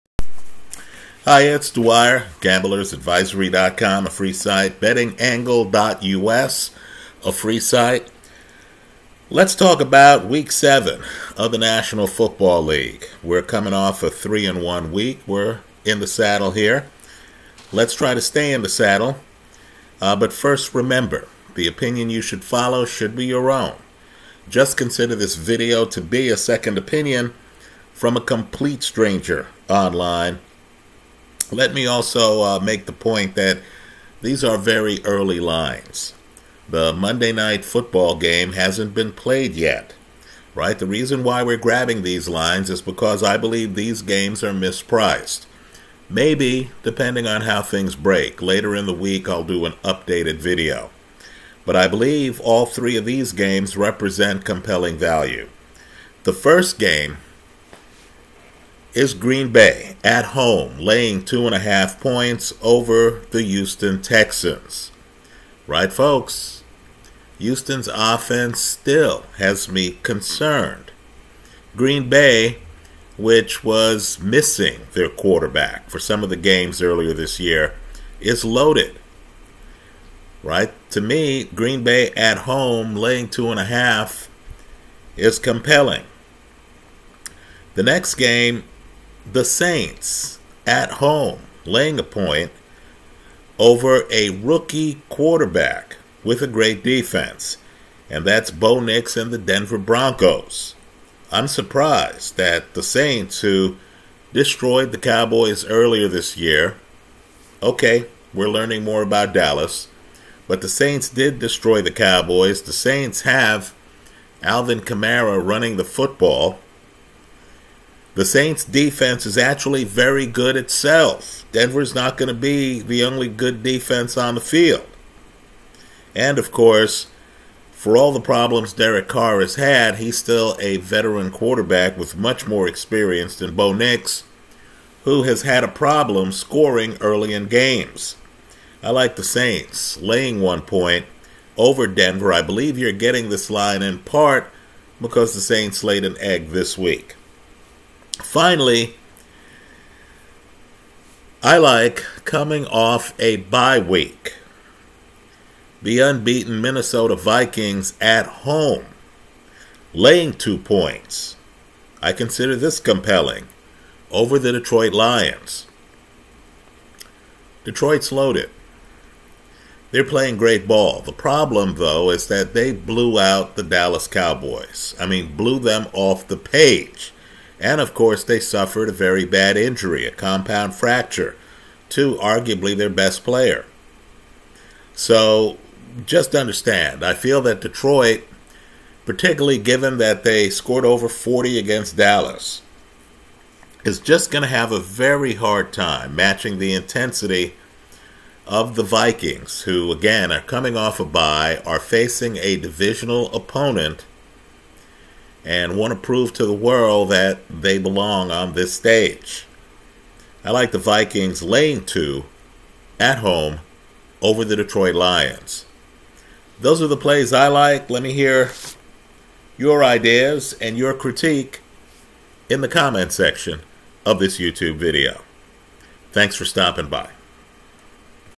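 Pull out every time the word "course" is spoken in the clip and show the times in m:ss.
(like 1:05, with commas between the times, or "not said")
2:06, 2:57.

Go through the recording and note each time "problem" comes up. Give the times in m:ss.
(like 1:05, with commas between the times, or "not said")
2:08, 2:15, 2:51.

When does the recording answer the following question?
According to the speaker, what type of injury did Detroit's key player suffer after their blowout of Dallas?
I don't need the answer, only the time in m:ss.
3:00.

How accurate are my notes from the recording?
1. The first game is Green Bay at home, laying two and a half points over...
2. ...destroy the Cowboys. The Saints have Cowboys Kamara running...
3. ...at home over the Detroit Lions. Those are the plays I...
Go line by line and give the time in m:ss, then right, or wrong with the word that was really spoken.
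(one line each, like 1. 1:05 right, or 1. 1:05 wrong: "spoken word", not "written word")
1. 0:56 right
2. 1:51 wrong: "Alvin", not "Cowboys"
3. 3:32 right.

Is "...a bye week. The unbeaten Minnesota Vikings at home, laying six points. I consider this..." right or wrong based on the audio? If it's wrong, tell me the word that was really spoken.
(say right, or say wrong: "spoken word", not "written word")
wrong: "two", not "six".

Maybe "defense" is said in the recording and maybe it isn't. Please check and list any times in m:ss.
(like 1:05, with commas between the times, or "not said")
1:36, 1:58, 2:03.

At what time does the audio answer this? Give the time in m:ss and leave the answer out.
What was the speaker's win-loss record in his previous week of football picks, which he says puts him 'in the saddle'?
0:14.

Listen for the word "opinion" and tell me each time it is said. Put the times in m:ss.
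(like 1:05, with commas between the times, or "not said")
0:21, 0:26.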